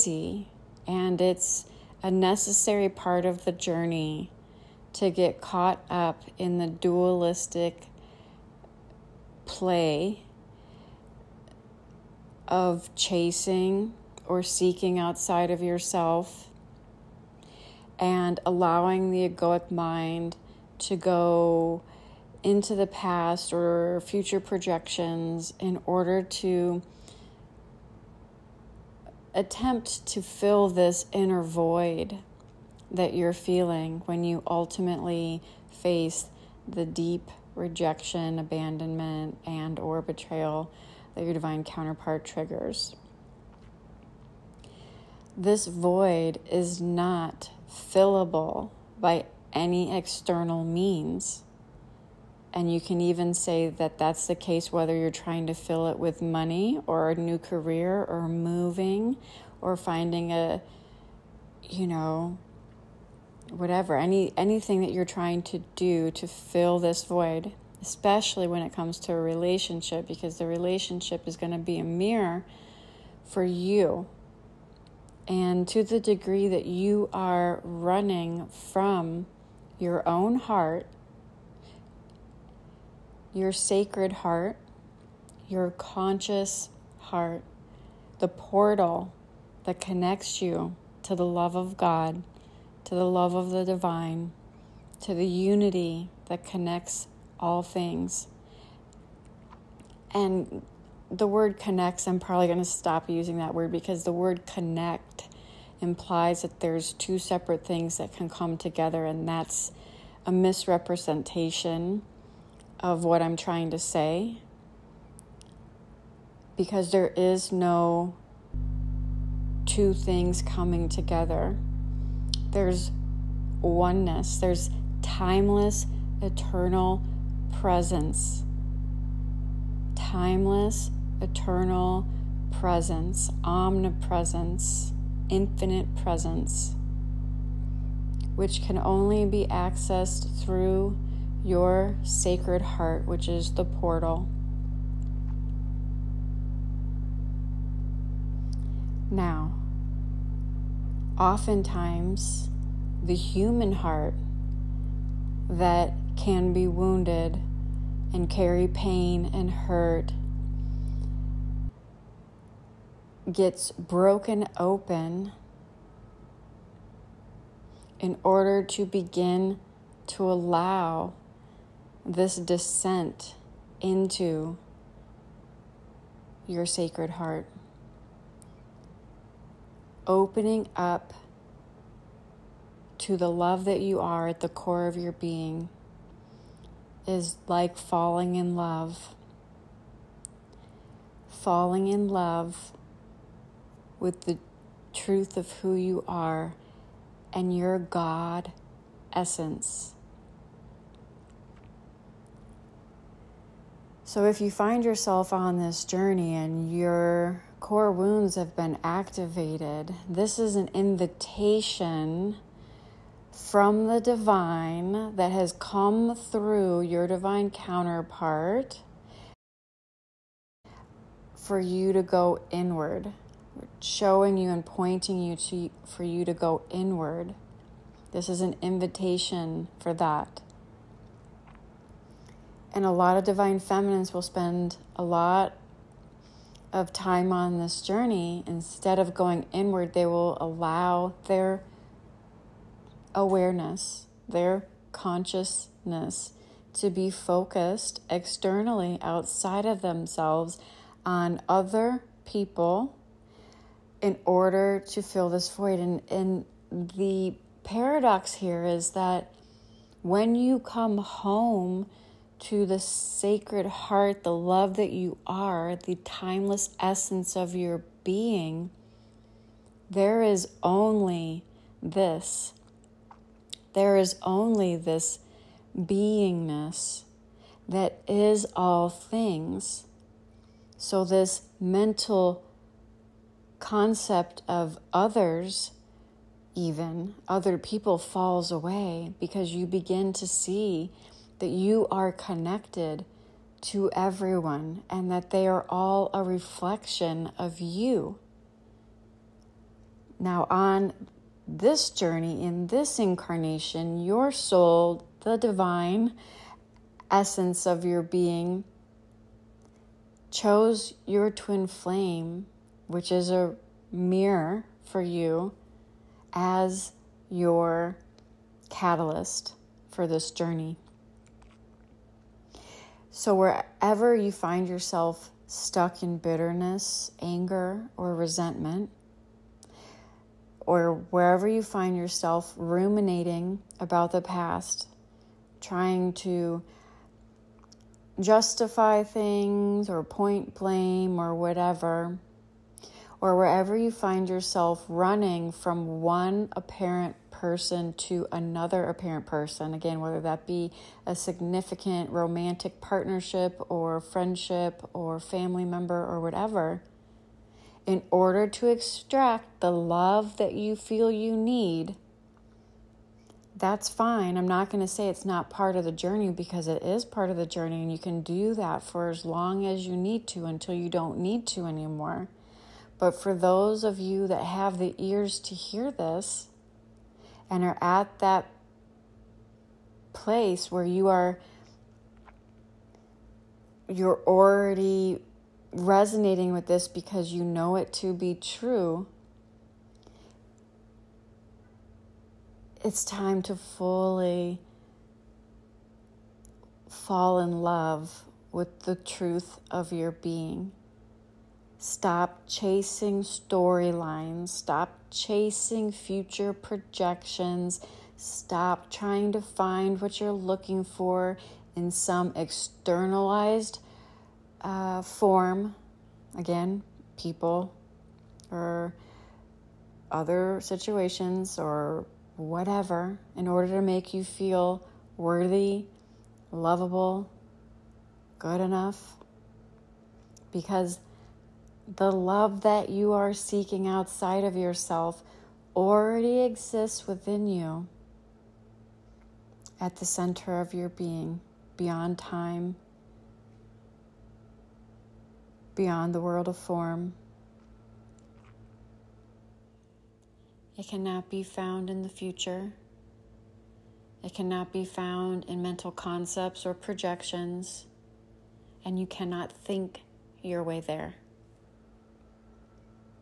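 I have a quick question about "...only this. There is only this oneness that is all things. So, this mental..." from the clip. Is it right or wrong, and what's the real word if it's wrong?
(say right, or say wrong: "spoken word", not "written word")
wrong: "beingness", not "oneness".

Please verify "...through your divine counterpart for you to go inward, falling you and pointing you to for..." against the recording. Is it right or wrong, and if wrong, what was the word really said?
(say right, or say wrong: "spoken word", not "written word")
wrong: "showing", not "falling".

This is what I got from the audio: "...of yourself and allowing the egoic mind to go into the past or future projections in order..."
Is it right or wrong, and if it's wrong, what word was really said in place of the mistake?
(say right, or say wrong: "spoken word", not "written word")
right.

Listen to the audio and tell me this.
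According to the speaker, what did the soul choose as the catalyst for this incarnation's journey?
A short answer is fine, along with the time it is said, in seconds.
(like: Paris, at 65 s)
Your twin flame, at 311 s.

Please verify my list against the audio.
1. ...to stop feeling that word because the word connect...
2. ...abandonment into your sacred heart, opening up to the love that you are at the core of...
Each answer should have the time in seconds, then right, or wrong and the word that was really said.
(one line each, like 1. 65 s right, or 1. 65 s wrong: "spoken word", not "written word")
1. 102 s wrong: "using", not "feeling"
2. 172 s wrong: "descent", not "abandonment".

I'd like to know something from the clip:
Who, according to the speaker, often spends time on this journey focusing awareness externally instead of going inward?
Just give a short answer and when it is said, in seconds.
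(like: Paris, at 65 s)
Divine feminines, at 233 s.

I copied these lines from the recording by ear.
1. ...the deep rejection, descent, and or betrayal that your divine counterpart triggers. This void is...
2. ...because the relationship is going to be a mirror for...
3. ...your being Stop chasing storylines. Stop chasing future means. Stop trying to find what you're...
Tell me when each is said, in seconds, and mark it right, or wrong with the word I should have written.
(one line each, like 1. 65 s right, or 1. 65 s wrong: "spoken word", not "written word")
1. 36 s wrong: "abandonment", not "descent"
2. 70 s right
3. 399 s wrong: "projections", not "means".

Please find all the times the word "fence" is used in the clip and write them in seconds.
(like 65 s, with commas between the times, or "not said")
not said.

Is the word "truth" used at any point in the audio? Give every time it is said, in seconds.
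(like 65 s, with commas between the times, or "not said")
194 s, 398 s.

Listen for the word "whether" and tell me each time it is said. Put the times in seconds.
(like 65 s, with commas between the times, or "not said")
54 s, 350 s.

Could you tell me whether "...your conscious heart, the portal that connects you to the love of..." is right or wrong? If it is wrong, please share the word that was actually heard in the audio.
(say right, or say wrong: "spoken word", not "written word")
right.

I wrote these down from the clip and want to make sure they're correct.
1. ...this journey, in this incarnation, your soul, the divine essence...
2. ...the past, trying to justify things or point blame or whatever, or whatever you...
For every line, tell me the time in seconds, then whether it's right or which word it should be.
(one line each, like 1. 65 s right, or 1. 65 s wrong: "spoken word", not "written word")
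1. 301 s right
2. 334 s wrong: "wherever", not "whatever".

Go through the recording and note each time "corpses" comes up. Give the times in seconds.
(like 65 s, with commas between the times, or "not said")
not said.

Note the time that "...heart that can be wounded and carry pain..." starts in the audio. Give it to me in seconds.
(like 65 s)
153 s.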